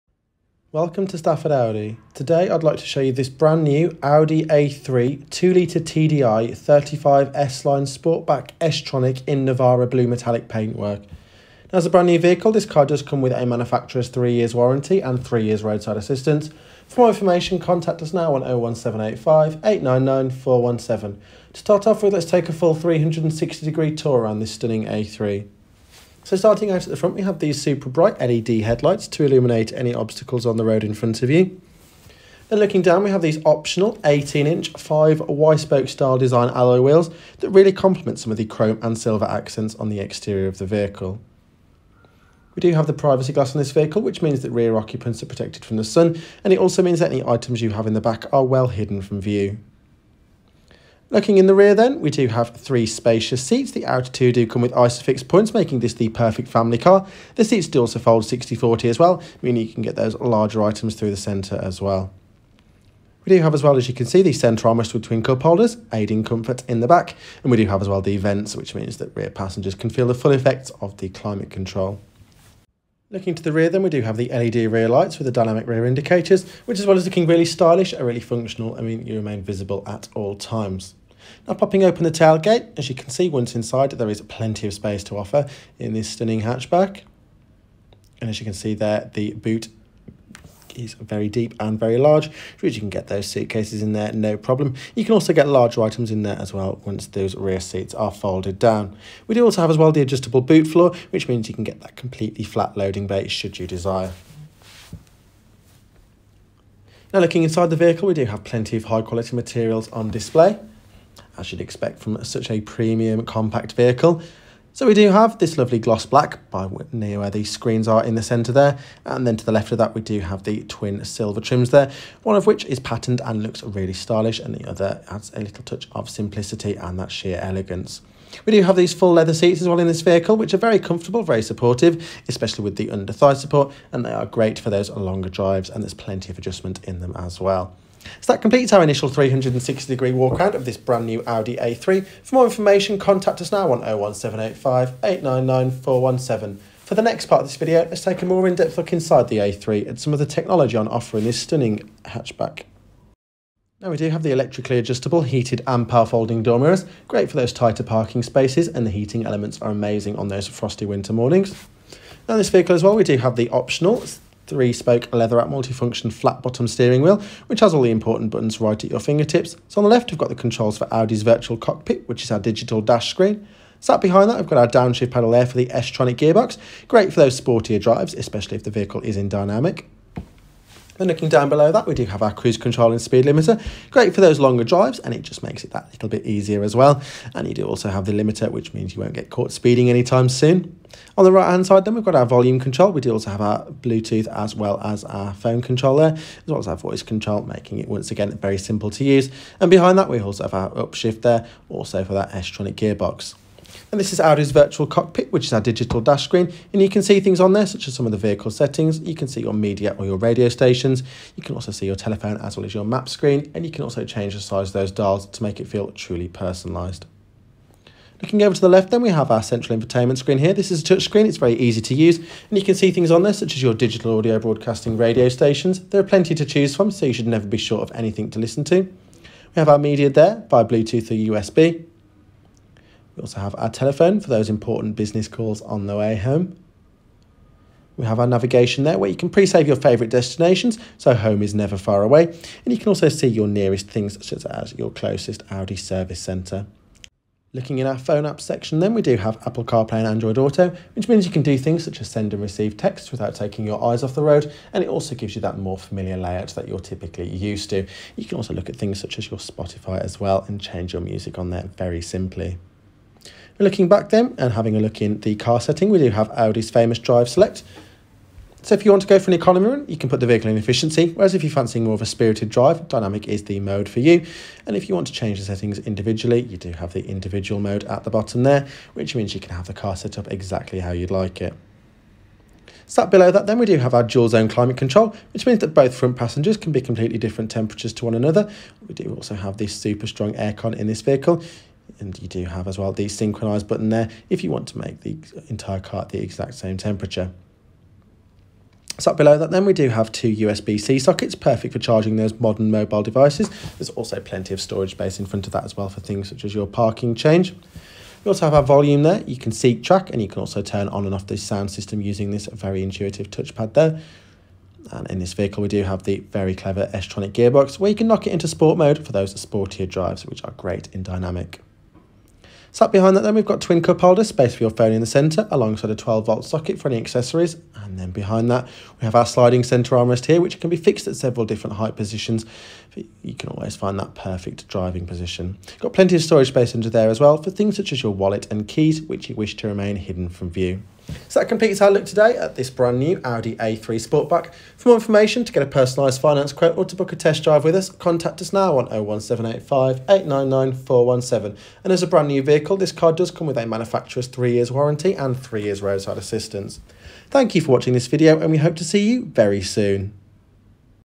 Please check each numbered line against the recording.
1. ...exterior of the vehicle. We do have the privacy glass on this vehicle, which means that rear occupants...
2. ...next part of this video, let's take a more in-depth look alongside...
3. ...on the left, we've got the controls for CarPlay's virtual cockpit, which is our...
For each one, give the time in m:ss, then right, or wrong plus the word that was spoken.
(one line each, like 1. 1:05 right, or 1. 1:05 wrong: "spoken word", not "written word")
1. 0:39 right
2. 2:27 wrong: "inside", not "alongside"
3. 2:49 wrong: "Audi", not "CarPlay".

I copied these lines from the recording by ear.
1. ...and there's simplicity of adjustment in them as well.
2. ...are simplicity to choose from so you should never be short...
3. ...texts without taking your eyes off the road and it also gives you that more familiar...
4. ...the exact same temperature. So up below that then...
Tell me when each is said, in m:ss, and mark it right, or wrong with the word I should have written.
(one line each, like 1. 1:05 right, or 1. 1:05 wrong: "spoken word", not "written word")
1. 2:15 wrong: "plenty", not "simplicity"
2. 3:45 wrong: "plenty", not "simplicity"
3. 4:12 right
4. 4:56 right.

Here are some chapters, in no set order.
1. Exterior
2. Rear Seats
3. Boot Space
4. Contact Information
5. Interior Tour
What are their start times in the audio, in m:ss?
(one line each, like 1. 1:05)
1. 0:20
2. 0:48
3. 1:22
4. 5:09
5. 2:38.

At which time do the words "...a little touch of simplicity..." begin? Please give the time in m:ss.
2:05.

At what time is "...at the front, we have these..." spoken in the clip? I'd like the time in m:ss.
0:26.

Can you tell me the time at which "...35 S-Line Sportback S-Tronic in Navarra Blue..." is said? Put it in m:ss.
0:06.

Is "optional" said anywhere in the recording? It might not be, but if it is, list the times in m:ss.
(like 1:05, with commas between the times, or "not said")
0:33, 2:43.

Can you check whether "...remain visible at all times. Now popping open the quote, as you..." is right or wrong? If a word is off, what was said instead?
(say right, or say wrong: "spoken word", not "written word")
wrong: "tailgate", not "quote".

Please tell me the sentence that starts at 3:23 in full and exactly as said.
And this is Audi's virtual cockpit, which is our digital dash screen.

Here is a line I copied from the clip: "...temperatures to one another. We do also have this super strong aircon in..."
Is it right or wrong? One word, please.
right.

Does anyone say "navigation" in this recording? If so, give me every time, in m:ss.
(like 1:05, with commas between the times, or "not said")
3:58.